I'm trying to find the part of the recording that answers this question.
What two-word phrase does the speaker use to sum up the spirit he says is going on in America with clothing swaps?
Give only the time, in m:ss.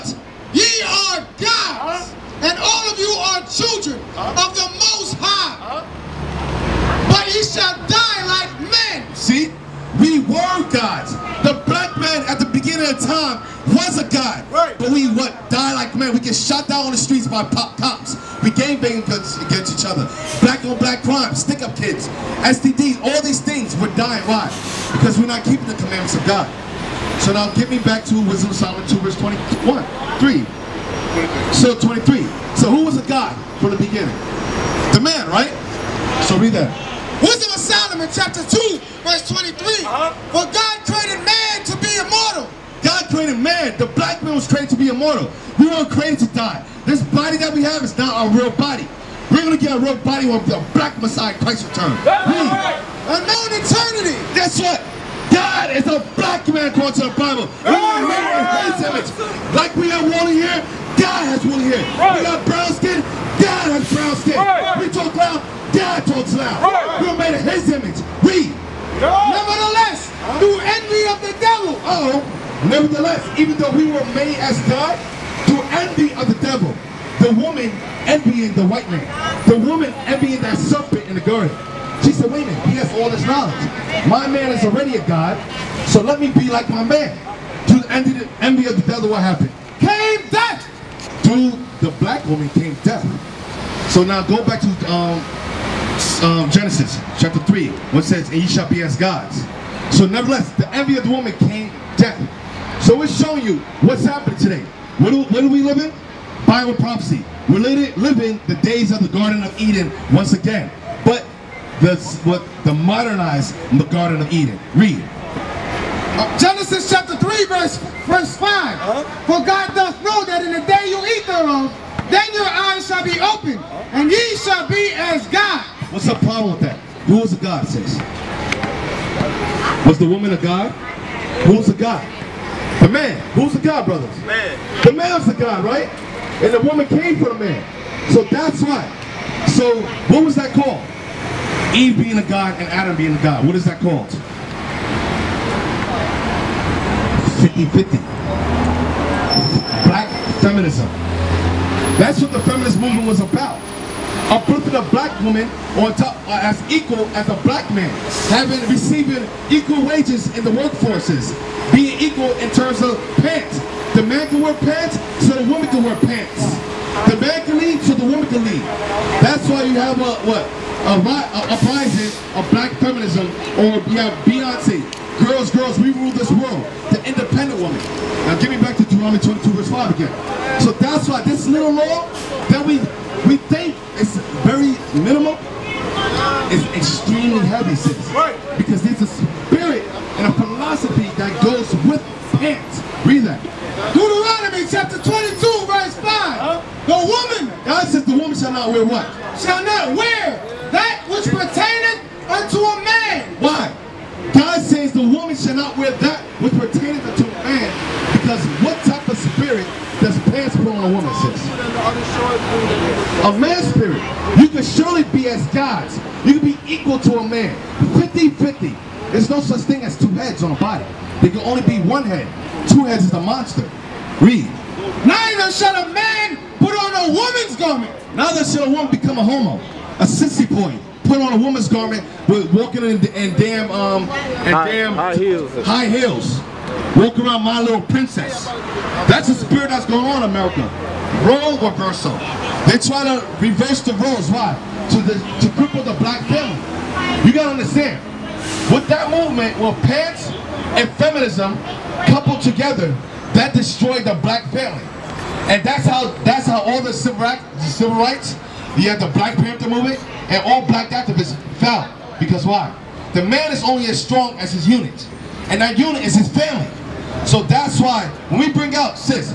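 4:01.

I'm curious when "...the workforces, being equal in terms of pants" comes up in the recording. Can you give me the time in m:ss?
2:40.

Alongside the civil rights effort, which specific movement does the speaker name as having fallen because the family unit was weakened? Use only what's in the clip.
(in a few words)
Black Panther movement.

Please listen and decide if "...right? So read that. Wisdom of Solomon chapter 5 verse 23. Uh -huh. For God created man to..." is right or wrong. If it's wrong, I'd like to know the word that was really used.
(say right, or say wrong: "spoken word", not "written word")
wrong: "2", not "5".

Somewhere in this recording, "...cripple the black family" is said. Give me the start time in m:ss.
4:05.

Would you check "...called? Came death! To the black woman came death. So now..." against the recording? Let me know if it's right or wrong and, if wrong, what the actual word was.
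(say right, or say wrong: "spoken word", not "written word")
wrong: "happened", not "called".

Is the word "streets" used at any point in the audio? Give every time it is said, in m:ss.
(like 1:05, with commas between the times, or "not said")
0:16.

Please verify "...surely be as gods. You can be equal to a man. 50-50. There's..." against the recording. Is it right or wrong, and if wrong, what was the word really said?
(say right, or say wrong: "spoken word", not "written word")
right.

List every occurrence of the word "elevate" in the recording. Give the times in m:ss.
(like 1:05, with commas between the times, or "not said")
not said.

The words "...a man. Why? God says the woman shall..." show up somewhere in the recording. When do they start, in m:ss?
3:22.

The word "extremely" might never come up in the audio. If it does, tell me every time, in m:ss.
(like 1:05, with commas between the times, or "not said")
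3:06.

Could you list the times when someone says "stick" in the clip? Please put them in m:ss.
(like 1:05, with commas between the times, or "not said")
0:21.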